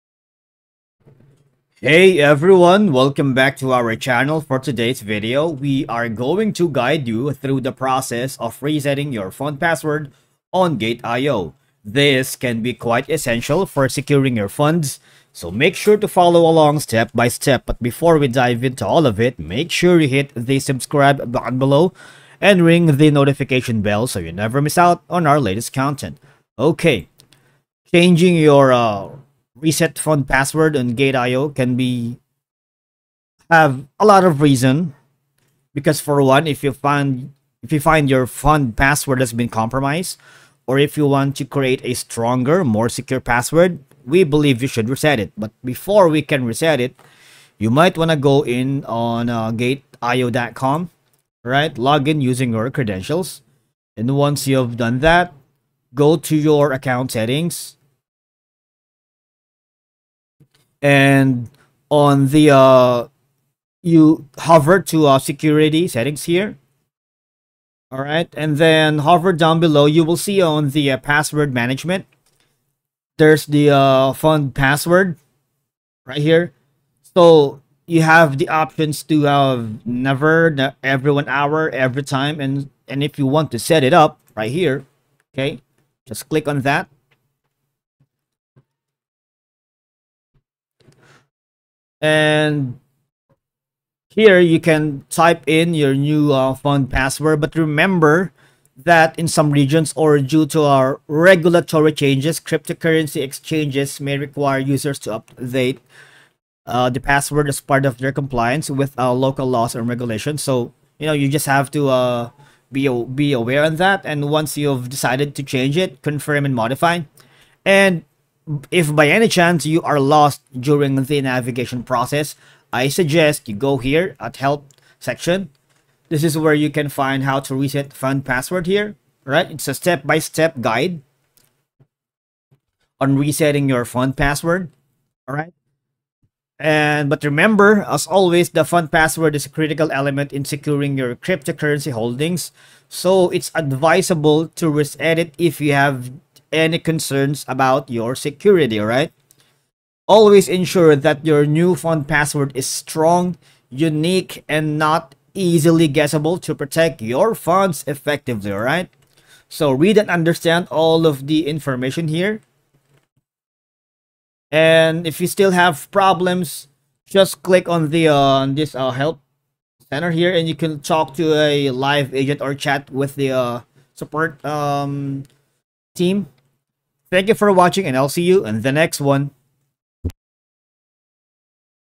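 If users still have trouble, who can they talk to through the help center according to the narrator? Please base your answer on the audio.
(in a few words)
A live agent.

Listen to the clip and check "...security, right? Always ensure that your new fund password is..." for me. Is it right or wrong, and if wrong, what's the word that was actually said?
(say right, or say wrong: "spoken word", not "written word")
right.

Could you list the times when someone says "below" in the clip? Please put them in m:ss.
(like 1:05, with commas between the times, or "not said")
0:21, 1:09.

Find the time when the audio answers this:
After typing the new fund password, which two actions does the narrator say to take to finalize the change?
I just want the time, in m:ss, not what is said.
1:56.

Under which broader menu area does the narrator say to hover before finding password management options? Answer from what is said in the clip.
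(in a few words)
Security settings.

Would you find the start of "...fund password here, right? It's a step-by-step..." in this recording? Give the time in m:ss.
2:07.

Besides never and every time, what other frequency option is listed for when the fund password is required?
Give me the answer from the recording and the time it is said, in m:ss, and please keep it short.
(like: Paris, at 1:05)
Every one hour, at 1:20.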